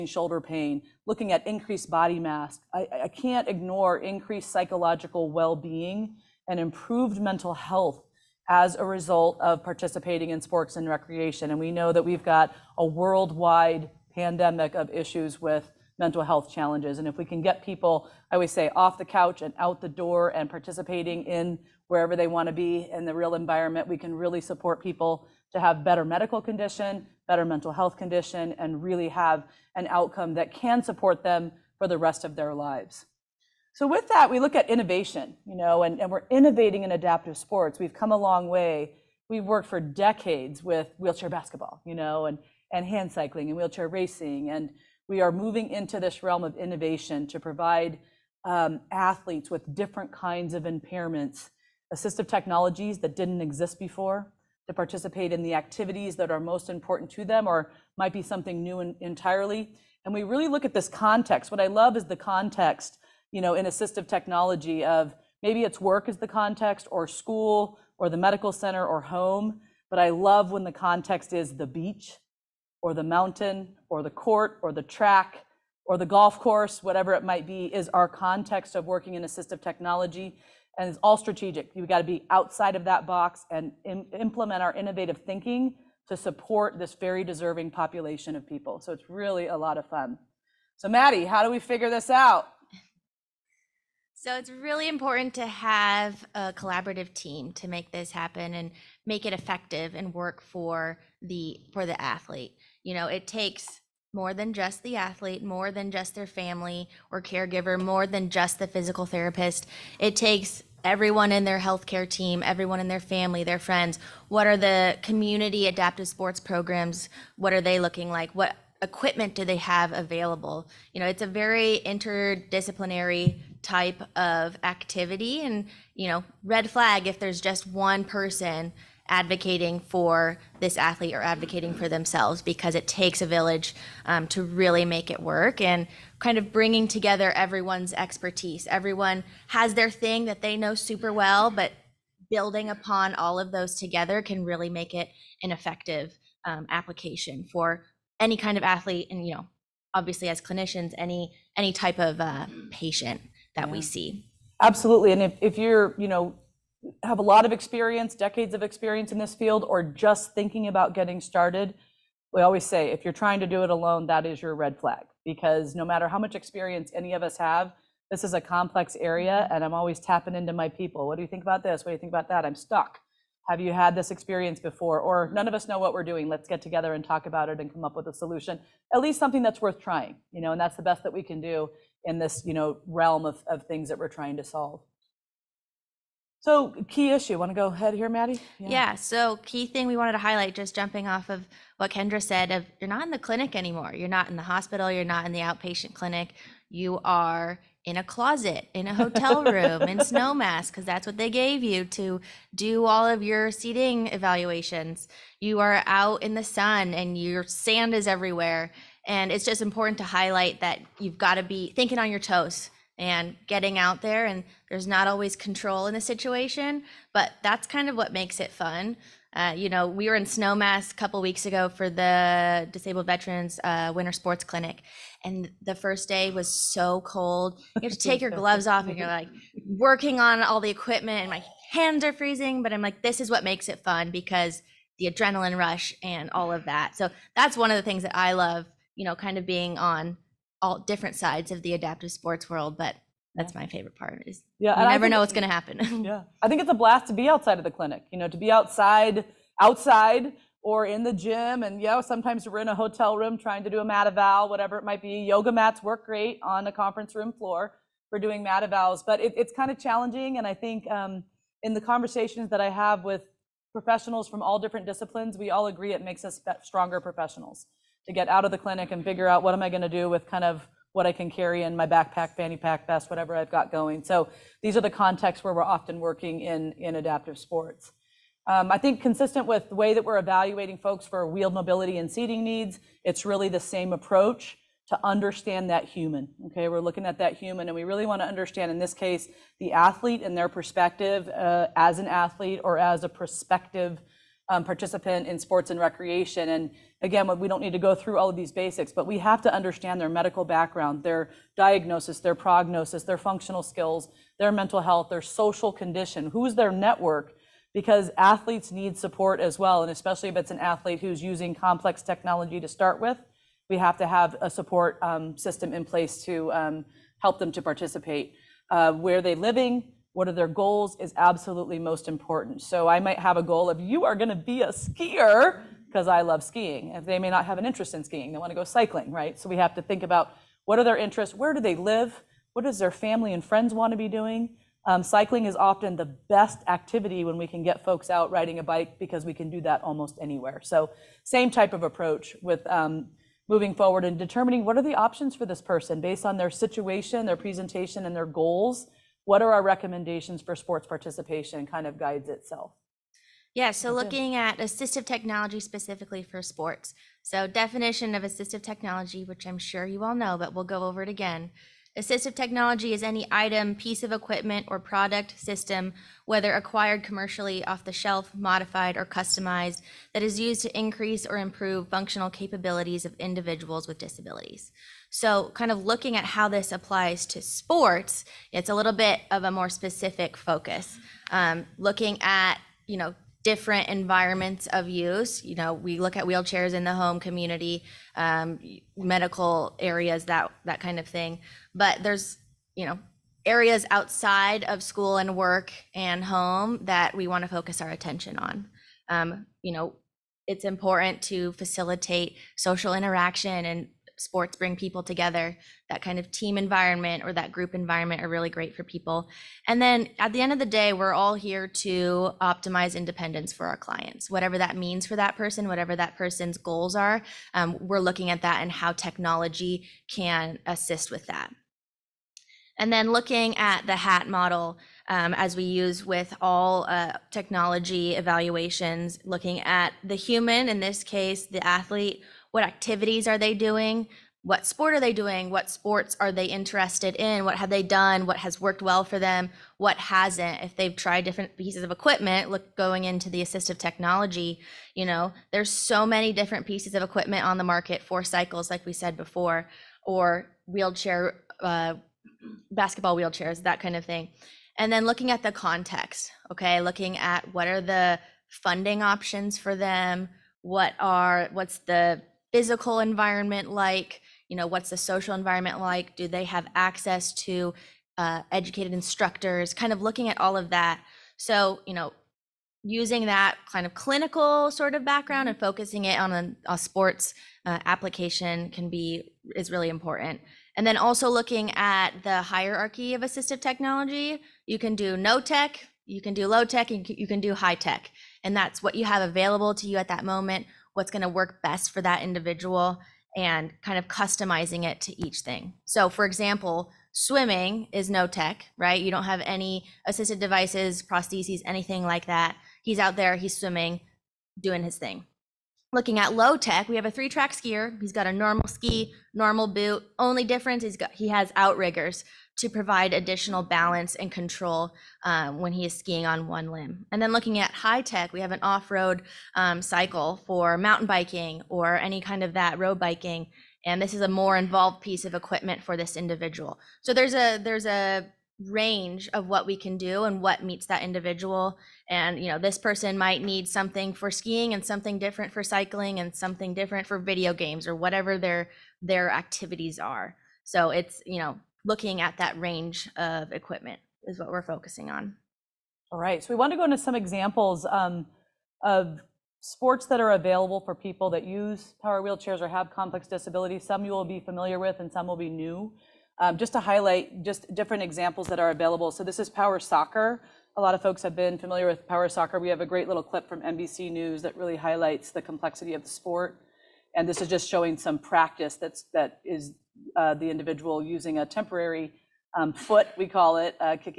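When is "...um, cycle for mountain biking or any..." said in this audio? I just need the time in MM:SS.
08:39.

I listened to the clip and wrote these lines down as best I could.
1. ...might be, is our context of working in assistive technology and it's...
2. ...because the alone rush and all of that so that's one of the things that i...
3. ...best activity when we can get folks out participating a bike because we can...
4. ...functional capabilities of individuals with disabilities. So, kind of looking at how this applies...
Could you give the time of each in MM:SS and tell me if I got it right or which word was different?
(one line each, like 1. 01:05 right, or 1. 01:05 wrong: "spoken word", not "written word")
1. 01:17 right
2. 03:54 wrong: "adrenaline", not "alone"
3. 05:36 wrong: "riding", not "participating"
4. 06:11 right.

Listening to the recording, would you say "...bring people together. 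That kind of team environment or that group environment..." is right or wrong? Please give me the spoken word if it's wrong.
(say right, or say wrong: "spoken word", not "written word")
right.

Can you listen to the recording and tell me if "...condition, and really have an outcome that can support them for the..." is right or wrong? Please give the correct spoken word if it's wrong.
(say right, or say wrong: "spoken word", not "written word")
right.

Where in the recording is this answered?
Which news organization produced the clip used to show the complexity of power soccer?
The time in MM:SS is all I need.
09:23.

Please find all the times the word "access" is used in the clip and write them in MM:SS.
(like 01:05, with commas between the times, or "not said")
07:46.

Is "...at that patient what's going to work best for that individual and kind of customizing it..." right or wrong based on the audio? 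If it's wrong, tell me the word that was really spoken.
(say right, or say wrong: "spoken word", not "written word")
wrong: "moment", not "patient".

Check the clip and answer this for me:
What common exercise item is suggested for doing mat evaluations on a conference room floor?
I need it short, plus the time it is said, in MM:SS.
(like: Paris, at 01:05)
Yoga mats, at 04:15.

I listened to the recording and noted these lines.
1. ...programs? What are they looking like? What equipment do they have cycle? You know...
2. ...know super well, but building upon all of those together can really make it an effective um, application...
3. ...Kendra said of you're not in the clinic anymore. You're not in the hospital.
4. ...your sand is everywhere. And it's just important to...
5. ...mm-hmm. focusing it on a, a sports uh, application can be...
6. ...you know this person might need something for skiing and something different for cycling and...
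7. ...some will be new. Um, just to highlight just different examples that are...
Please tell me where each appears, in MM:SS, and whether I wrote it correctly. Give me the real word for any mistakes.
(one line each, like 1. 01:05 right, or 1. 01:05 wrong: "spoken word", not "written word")
1. 01:56 wrong: "available", not "cycle"
2. 02:20 right
3. 03:11 right
4. 03:27 right
5. 07:55 right
6. 08:52 right
7. 09:15 right.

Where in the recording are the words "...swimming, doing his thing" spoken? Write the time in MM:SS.
08:23.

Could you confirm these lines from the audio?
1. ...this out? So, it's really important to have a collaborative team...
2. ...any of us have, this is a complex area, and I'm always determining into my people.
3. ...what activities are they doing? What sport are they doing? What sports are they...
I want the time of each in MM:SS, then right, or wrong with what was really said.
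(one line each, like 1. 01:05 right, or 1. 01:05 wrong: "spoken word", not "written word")
1. 01:31 right
2. 02:46 wrong: "tapping", not "determining"
3. 07:12 right.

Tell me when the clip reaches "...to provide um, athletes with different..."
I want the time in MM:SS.
00:47.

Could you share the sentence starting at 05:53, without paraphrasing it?
Yeah, so looking at assistive technology specifically for sports.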